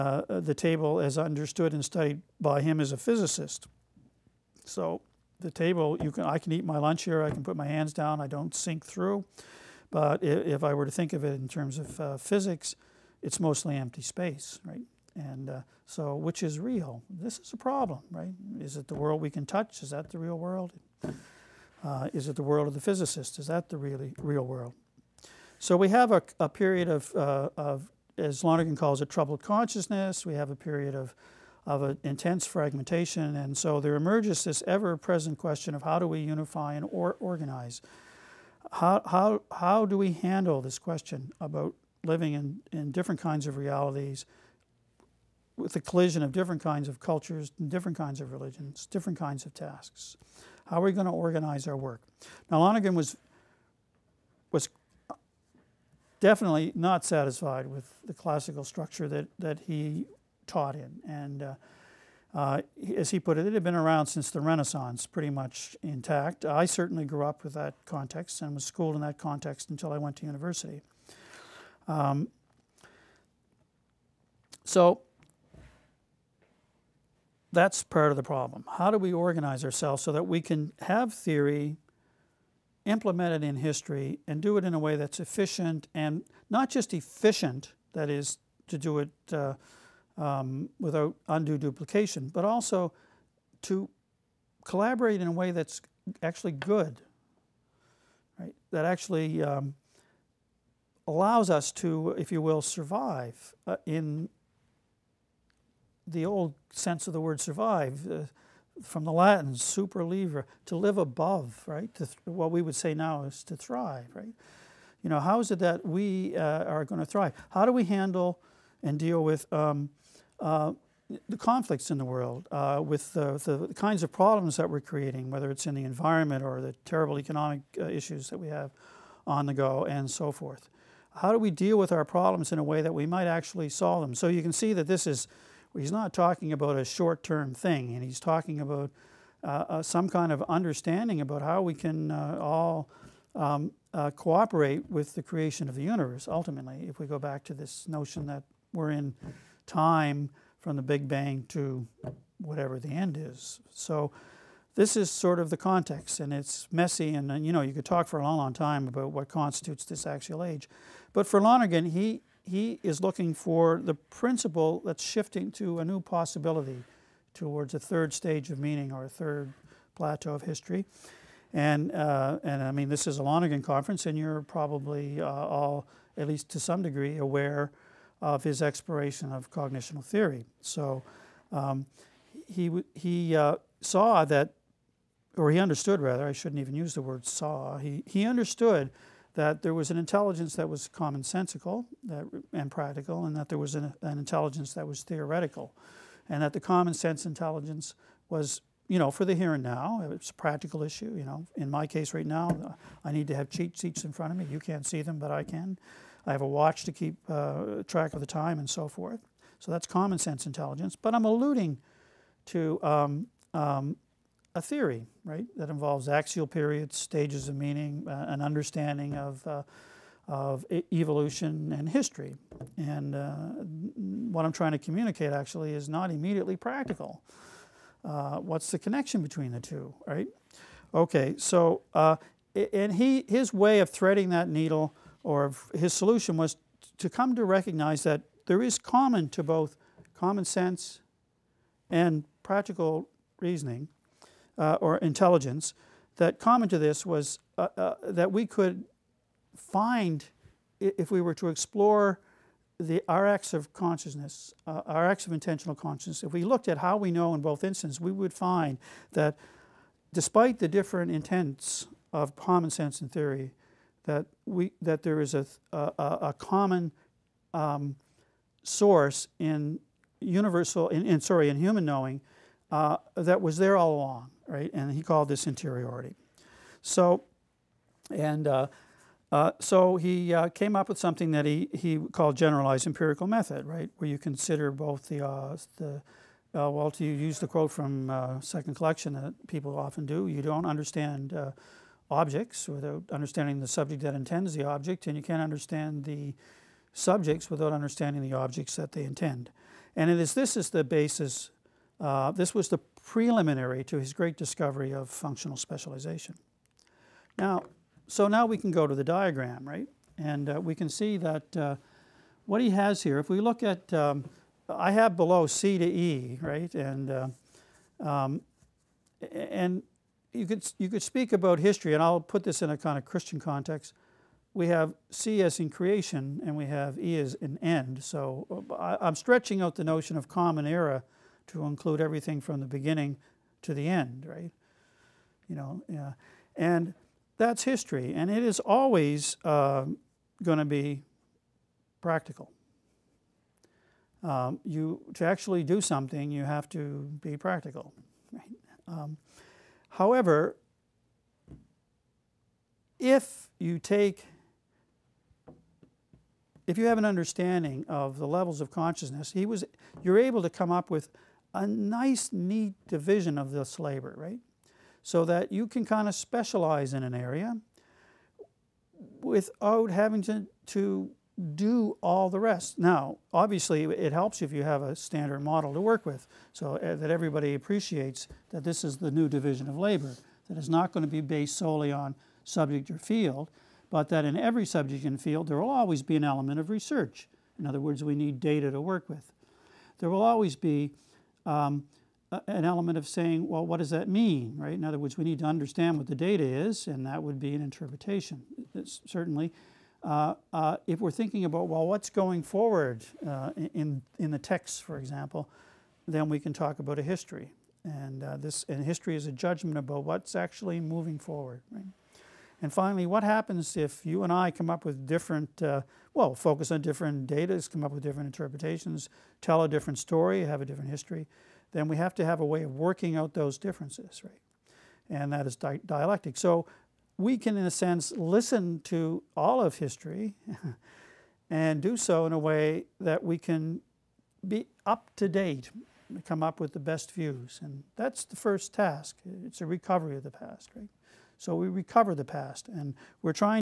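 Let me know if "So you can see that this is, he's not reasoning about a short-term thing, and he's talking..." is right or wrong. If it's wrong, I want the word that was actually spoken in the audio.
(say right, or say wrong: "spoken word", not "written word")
wrong: "talking", not "reasoning".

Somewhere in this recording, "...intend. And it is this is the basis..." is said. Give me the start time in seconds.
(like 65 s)
299 s.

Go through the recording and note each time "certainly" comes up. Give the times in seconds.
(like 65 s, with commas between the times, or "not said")
66 s, 399 s.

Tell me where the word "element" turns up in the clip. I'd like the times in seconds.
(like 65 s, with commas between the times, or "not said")
386 s, 392 s.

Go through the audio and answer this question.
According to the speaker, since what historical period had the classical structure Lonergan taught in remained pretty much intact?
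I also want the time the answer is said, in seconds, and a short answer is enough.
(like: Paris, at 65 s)
the Renaissance, at 64 s.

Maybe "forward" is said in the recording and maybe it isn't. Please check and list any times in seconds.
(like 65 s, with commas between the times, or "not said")
402 s, 411 s.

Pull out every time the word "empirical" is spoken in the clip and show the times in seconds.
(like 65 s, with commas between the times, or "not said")
282 s.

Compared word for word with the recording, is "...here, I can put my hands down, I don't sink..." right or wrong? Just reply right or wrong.
right.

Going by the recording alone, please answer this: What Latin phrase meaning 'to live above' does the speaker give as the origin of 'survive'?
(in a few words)
super livre.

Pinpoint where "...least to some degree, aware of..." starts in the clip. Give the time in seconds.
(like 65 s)
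176 s.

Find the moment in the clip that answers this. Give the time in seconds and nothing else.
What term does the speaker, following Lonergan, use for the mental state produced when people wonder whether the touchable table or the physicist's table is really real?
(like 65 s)
29 s.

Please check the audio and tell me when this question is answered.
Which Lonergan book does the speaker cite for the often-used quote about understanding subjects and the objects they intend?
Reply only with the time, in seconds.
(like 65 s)
288 s.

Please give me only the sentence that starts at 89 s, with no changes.
Uh, um, without undue duplication, but also to collaborate in a way that's actually good, right?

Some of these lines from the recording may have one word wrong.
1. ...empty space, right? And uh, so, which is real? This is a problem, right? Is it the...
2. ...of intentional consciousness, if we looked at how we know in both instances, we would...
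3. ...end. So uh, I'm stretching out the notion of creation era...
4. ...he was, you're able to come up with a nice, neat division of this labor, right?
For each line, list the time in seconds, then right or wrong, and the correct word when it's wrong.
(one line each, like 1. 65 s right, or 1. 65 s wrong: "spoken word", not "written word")
1. 13 s right
2. 255 s right
3. 327 s wrong: "common", not "creation"
4. 359 s right.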